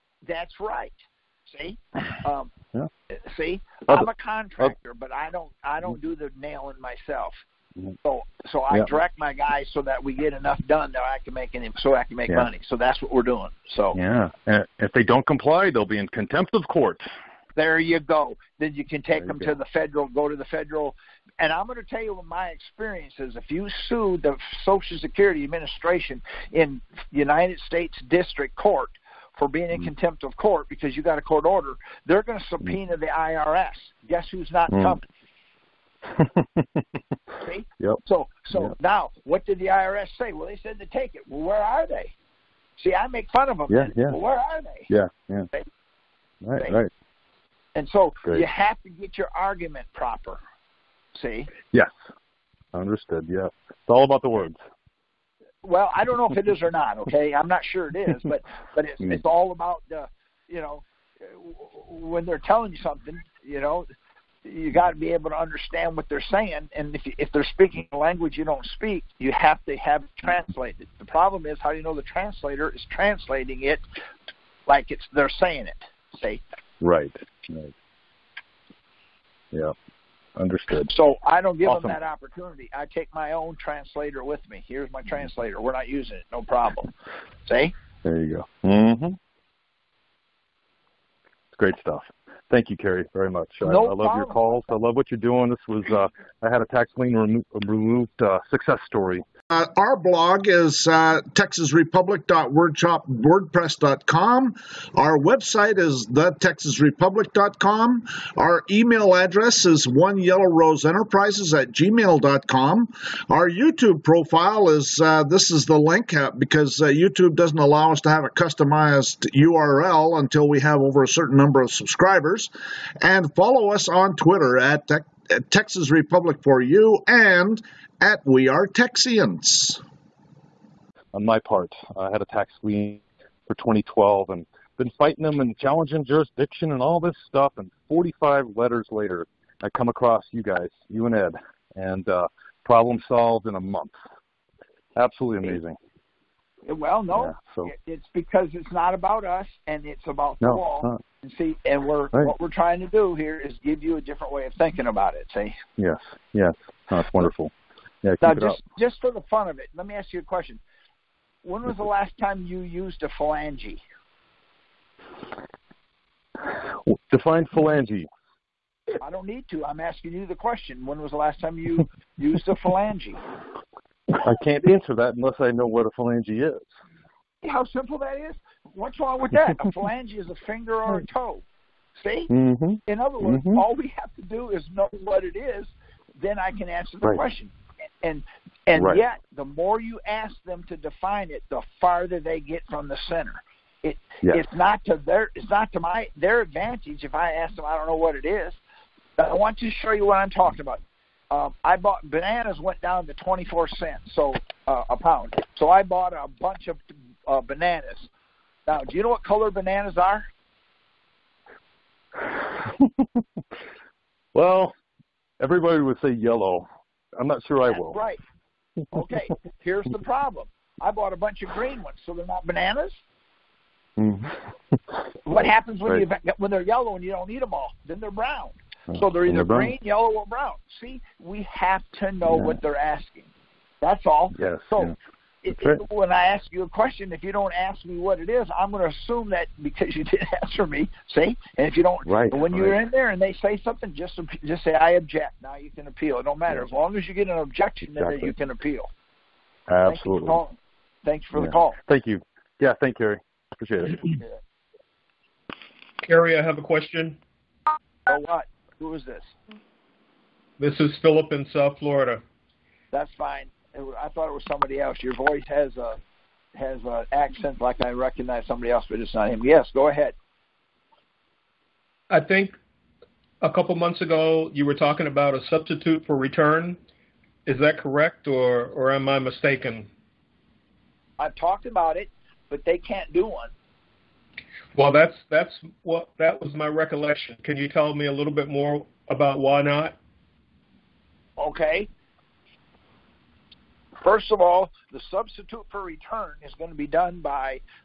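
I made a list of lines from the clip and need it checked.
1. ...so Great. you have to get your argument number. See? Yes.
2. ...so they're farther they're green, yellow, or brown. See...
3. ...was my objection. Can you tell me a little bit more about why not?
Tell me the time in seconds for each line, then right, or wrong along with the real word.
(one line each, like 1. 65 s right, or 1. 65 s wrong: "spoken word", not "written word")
1. 47 s wrong: "proper", not "number"
2. 228 s wrong: "either", not "farther"
3. 286 s wrong: "recollection", not "objection".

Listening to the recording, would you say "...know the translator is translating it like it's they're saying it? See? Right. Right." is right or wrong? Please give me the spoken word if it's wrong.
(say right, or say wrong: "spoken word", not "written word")
right.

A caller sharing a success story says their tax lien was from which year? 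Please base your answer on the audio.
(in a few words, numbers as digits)
2012.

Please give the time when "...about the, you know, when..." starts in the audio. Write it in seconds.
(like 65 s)
59 s.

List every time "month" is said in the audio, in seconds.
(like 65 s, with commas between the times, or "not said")
143 s, 273 s.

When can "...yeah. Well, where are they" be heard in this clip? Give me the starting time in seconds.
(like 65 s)
43 s.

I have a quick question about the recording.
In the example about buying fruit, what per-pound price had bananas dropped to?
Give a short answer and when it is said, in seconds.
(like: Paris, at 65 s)
24 cents, at 203 s.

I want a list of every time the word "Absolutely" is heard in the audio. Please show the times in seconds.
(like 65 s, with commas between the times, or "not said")
144 s, 249 s.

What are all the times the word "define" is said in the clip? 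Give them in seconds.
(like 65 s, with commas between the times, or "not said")
167 s, 190 s.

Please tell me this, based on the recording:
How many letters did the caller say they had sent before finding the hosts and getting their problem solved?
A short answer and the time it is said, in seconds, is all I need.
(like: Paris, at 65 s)
45, at 137 s.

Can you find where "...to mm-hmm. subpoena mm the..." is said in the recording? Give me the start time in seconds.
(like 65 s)
32 s.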